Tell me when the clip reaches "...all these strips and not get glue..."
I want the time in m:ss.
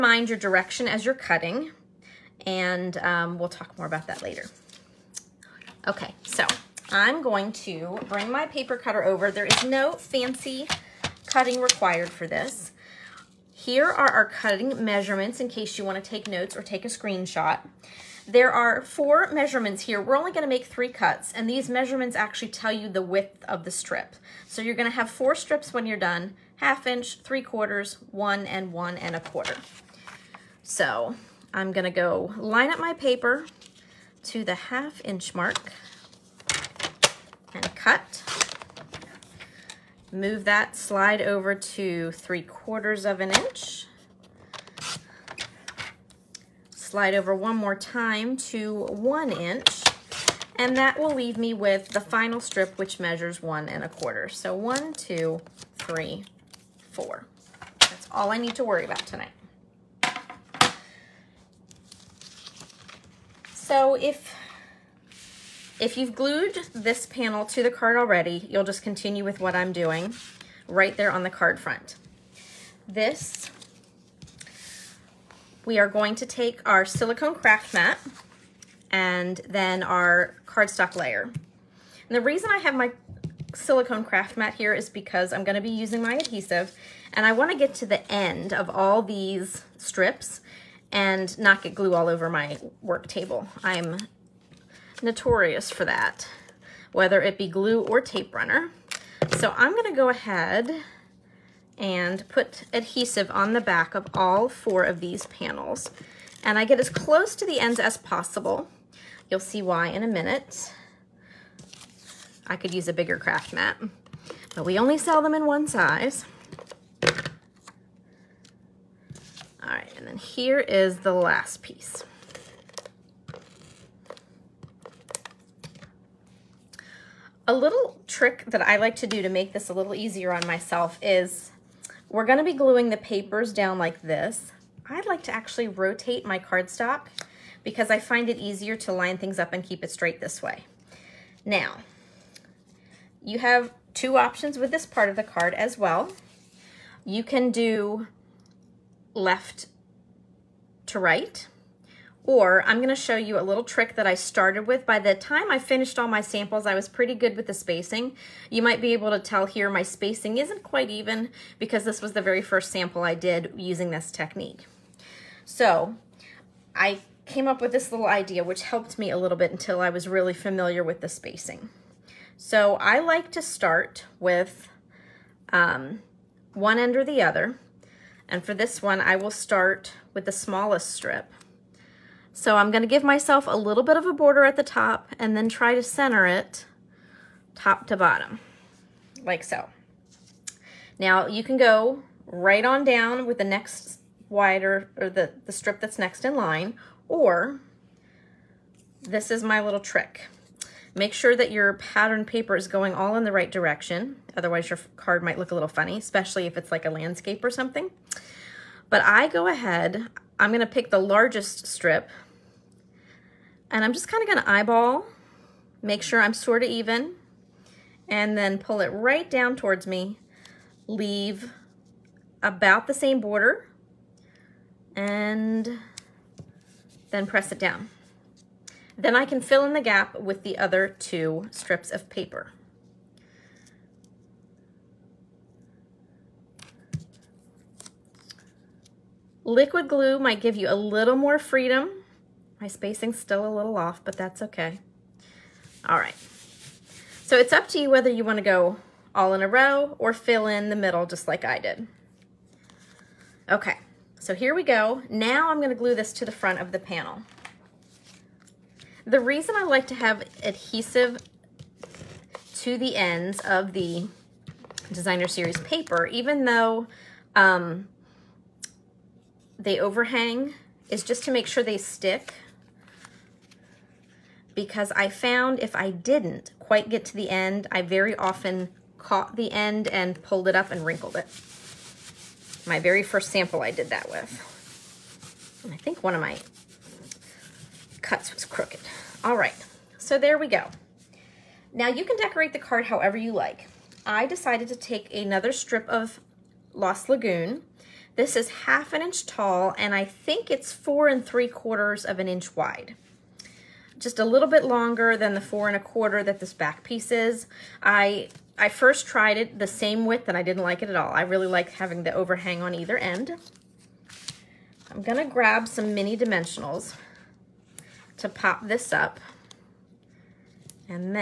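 1:28.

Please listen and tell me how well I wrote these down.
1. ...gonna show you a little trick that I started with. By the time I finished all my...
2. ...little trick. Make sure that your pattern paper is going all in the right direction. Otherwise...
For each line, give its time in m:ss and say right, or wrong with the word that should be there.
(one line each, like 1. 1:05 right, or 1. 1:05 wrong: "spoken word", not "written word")
1. 2:32 right
2. 3:19 right.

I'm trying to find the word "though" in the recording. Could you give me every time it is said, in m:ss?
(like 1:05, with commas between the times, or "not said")
4:26.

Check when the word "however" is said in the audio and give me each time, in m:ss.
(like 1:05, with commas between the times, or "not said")
4:52.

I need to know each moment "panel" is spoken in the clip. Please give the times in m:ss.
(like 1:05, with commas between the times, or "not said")
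1:07, 1:45, 4:16.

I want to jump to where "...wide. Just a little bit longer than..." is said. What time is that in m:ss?
5:02.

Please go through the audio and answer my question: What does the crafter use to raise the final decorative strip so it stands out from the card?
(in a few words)
mini dimensionals.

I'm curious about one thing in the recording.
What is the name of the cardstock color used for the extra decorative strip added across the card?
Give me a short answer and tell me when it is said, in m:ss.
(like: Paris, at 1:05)
Lost Lagoon, at 4:56.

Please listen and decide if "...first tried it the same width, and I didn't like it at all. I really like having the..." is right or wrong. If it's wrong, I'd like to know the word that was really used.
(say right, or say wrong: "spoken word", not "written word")
right.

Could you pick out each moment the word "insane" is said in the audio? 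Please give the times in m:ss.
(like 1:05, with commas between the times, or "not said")
not said.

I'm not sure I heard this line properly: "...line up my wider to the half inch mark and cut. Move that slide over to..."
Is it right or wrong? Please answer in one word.
wrong.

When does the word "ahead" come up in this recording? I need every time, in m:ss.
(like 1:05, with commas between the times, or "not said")
1:40, 3:29.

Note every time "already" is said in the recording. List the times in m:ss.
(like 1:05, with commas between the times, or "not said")
1:07.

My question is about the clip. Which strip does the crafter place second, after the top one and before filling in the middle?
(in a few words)
the largest strip.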